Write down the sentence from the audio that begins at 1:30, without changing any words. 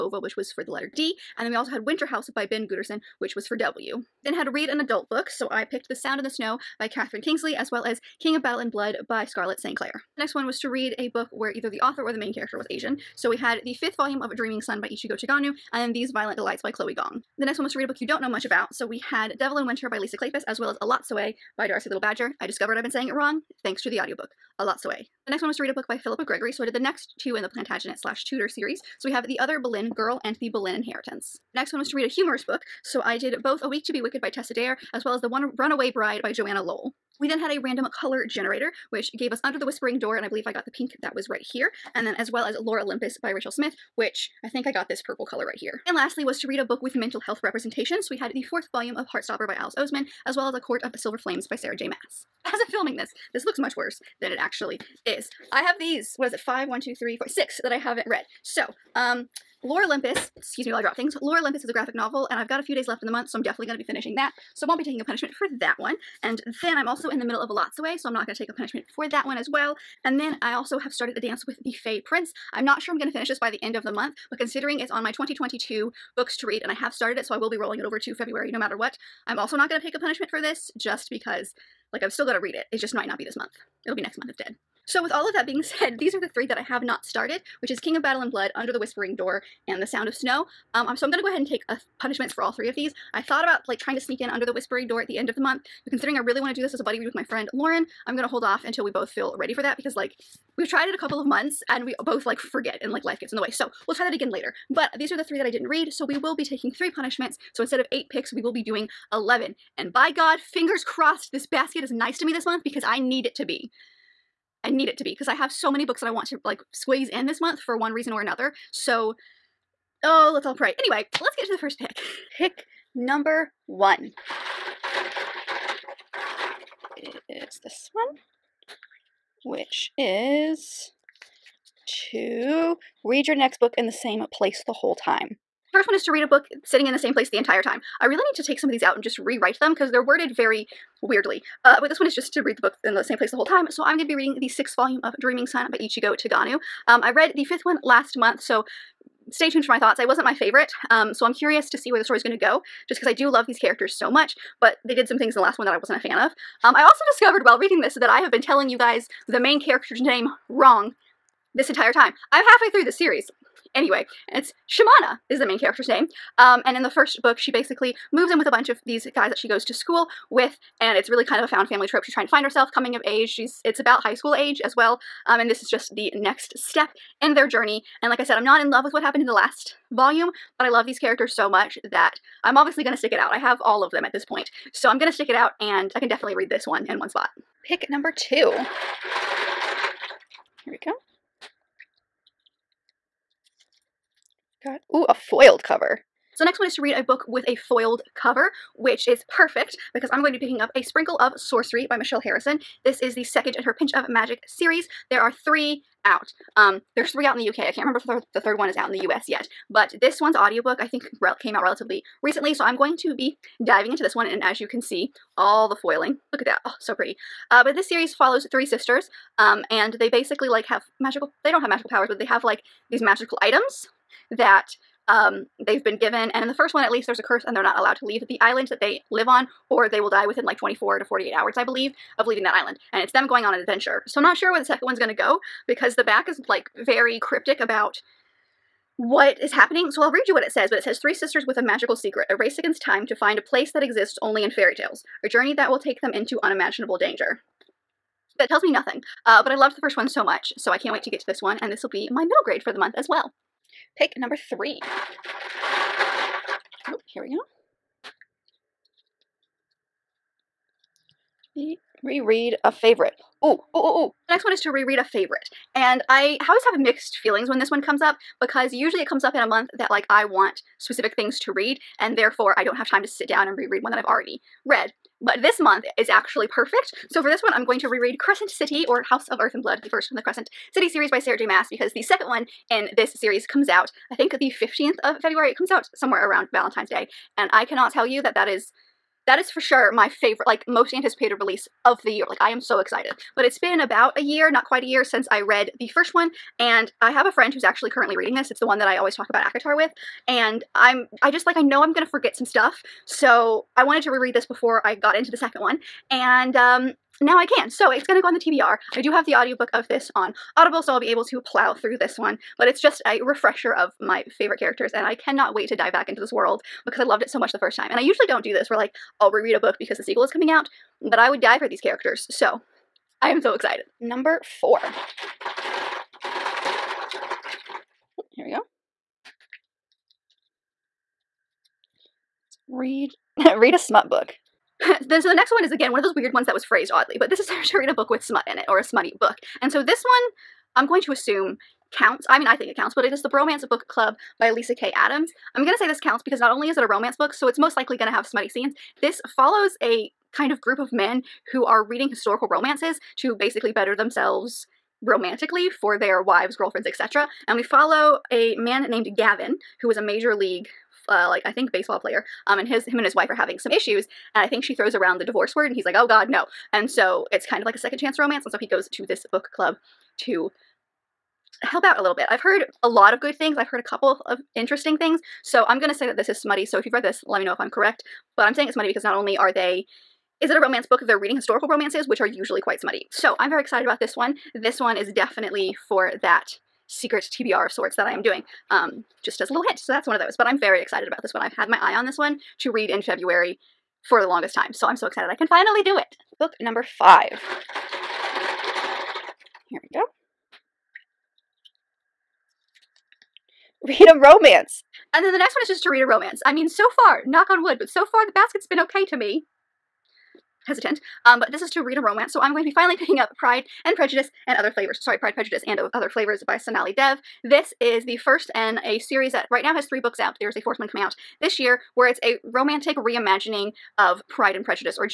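Um, um so I'm going to go ahead and take a punishments for all three of these.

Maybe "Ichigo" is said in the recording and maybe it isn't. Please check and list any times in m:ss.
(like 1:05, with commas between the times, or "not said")
0:14, 2:25.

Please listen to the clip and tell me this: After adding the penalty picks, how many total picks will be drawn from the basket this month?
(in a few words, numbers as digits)
11.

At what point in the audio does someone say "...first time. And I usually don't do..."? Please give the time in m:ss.
5:17.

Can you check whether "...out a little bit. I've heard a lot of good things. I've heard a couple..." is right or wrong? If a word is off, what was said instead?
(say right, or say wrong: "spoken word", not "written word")
right.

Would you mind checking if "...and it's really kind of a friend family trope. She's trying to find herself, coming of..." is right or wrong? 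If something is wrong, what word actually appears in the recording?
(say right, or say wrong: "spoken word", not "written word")
wrong: "found", not "friend".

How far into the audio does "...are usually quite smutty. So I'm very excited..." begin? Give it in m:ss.
6:22.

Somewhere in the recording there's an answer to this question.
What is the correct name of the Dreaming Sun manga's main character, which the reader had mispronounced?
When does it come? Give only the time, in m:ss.
2:44.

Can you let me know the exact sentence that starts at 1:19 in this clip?
I'm also not going to take a punishment for this, just because like, I'm still gonna read it.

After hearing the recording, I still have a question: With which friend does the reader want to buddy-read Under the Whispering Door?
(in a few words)
Lauren.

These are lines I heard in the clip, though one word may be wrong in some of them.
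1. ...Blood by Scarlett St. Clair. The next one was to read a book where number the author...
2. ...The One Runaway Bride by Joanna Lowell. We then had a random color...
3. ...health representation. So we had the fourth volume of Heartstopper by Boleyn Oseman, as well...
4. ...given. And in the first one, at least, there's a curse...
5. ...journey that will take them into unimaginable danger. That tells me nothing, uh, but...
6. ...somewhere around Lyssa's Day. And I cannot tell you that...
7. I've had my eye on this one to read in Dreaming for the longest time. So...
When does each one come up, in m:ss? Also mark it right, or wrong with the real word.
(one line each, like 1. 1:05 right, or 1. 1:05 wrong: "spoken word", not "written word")
1. 0:08 wrong: "either", not "number"
2. 0:35 right
3. 0:47 wrong: "Alice", not "Boleyn"
4. 3:45 right
5. 4:05 right
6. 4:45 wrong: "Valentine", not "Lyssa"
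7. 6:31 wrong: "February", not "Dreaming".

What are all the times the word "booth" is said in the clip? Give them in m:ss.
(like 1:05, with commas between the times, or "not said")
not said.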